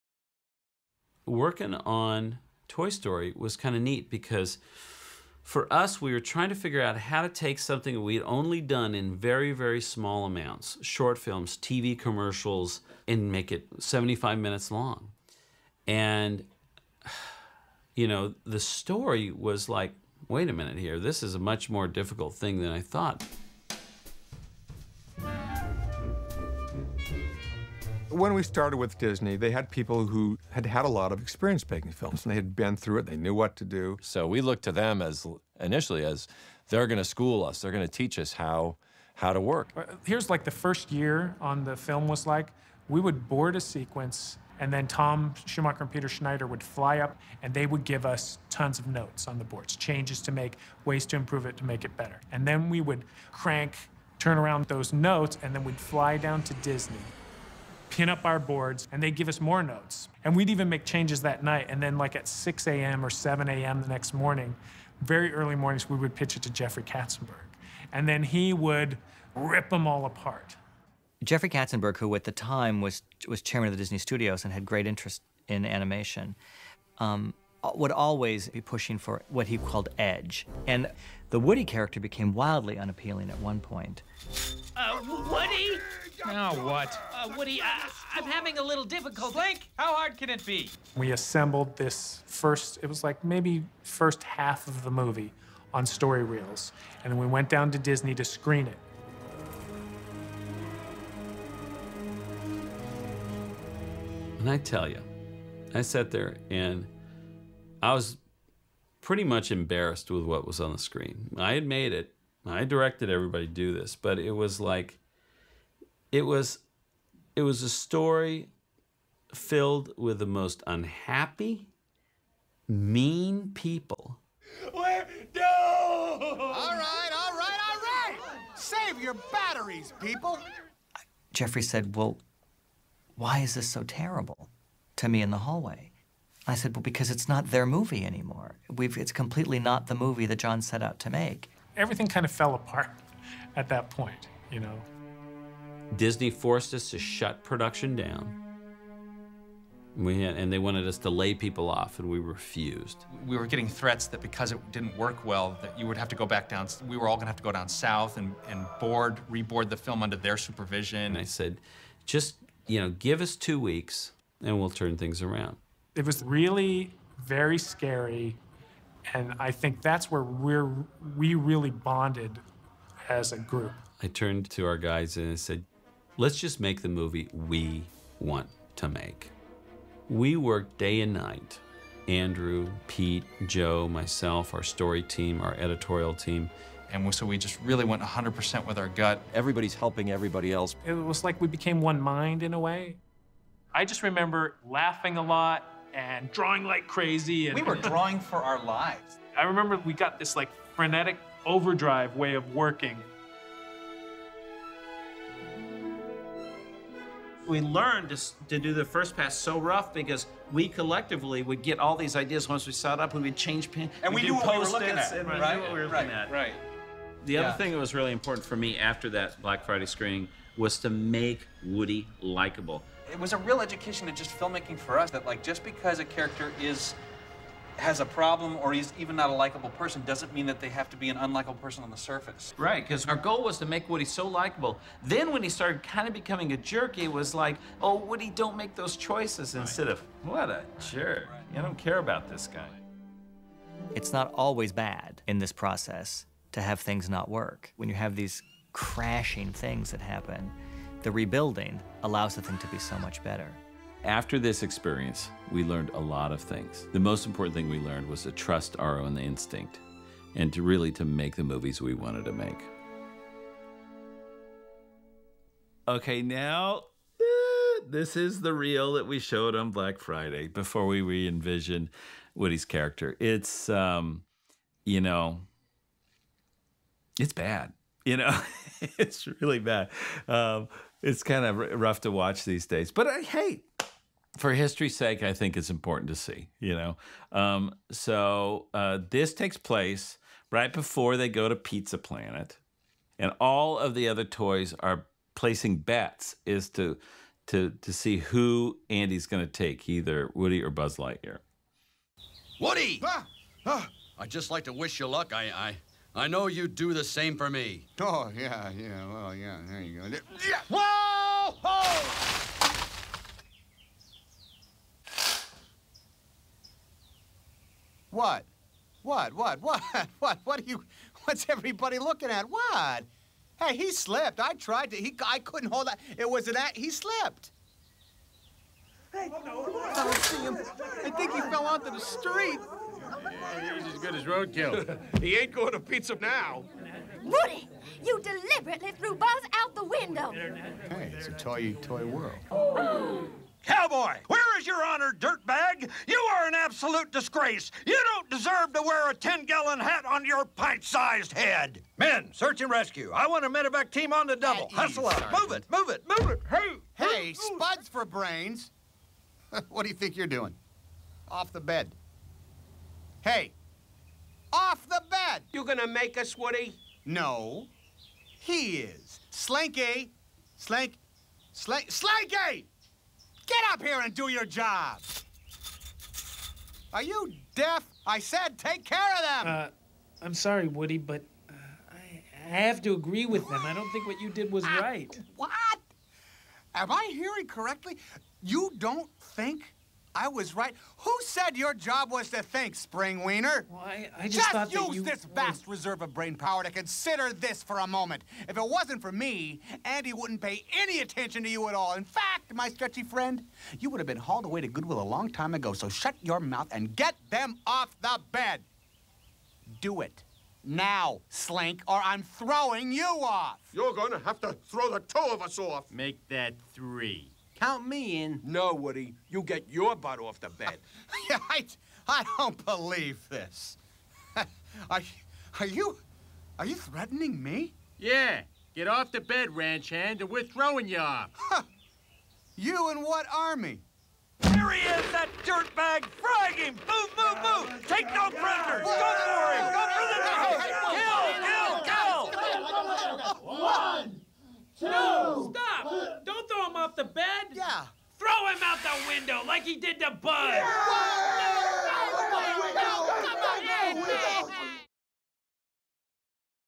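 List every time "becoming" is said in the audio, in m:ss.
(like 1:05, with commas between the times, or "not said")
3:56.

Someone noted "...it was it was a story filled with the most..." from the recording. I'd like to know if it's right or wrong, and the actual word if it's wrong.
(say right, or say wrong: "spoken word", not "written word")
right.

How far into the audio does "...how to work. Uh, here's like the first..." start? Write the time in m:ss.
0:39.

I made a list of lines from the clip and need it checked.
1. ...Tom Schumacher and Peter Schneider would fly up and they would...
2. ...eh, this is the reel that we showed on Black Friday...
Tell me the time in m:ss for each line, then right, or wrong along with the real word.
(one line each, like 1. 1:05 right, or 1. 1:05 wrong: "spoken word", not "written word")
1. 0:44 right
2. 4:27 right.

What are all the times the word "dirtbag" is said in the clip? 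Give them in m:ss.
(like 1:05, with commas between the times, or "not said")
5:45, 7:15.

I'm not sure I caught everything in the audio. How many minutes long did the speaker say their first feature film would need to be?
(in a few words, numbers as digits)
75.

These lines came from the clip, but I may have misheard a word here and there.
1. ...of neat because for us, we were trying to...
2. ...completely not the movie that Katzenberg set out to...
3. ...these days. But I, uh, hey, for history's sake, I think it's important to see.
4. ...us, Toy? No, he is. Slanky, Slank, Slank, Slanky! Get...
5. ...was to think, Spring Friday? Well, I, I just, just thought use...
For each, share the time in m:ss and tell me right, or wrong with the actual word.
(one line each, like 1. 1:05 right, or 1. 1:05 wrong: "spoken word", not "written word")
1. 0:03 right
2. 2:19 wrong: "John", not "Katzenberg"
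3. 4:42 right
4. 6:06 wrong: "Woody", not "Toy"
5. 6:32 wrong: "Wiener", not "Friday".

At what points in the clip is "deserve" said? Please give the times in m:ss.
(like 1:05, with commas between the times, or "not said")
5:48.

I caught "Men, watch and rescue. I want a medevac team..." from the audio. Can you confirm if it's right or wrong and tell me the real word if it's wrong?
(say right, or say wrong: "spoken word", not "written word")
wrong: "search", not "watch".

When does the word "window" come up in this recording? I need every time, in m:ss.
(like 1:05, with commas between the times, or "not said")
5:39, 7:29.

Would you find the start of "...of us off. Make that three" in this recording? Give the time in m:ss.
6:55.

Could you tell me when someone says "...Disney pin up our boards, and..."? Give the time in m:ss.
0:56.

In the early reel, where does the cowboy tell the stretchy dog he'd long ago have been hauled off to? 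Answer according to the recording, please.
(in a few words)
Goodwill.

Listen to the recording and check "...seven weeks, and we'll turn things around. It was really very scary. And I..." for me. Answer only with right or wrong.
wrong.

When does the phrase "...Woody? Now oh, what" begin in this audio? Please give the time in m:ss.
1:25.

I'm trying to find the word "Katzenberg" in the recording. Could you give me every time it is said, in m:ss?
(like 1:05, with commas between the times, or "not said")
1:06, 1:11.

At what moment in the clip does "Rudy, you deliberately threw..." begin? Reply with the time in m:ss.
5:37.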